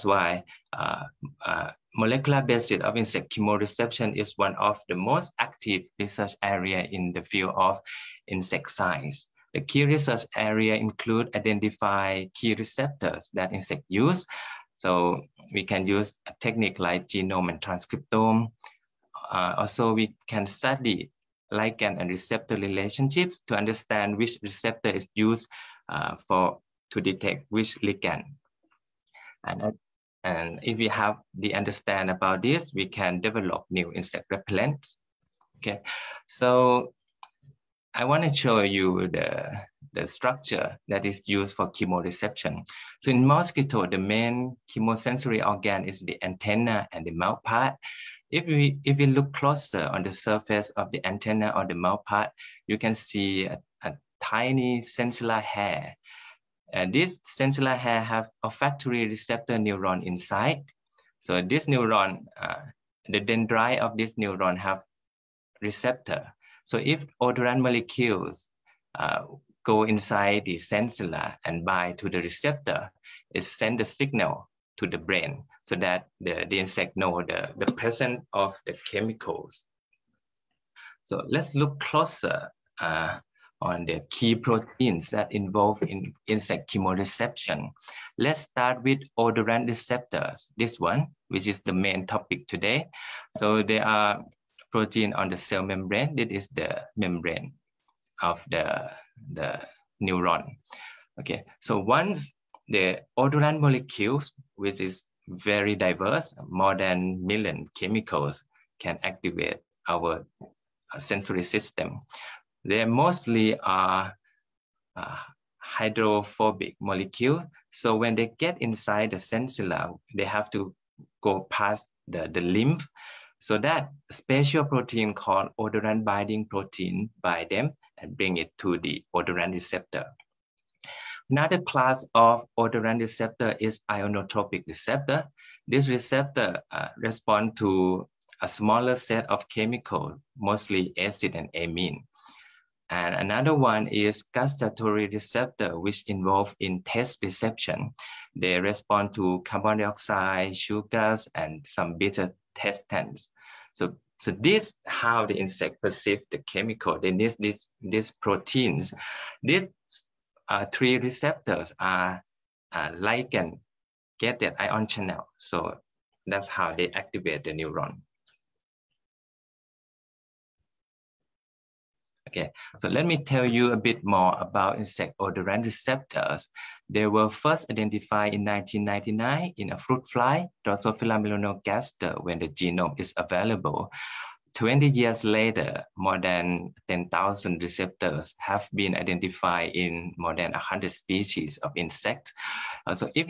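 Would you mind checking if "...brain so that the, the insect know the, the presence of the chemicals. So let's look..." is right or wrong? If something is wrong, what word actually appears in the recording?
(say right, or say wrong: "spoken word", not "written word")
right.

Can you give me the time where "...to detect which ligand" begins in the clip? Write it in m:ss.
0:26.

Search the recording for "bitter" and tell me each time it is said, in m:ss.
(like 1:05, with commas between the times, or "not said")
2:31.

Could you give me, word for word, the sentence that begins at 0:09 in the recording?
The key research area include identify key receptors that insect use, so we can use a technique like genome and transcriptome.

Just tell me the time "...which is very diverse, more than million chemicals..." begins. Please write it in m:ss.
1:44.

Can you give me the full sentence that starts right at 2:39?
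These uh, three receptors are uh, ligand that ion channel.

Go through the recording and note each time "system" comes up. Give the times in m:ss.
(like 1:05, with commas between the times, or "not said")
1:51.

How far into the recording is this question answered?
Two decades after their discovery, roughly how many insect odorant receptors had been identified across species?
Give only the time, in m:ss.
3:05.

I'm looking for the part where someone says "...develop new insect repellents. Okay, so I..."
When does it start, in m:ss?
0:33.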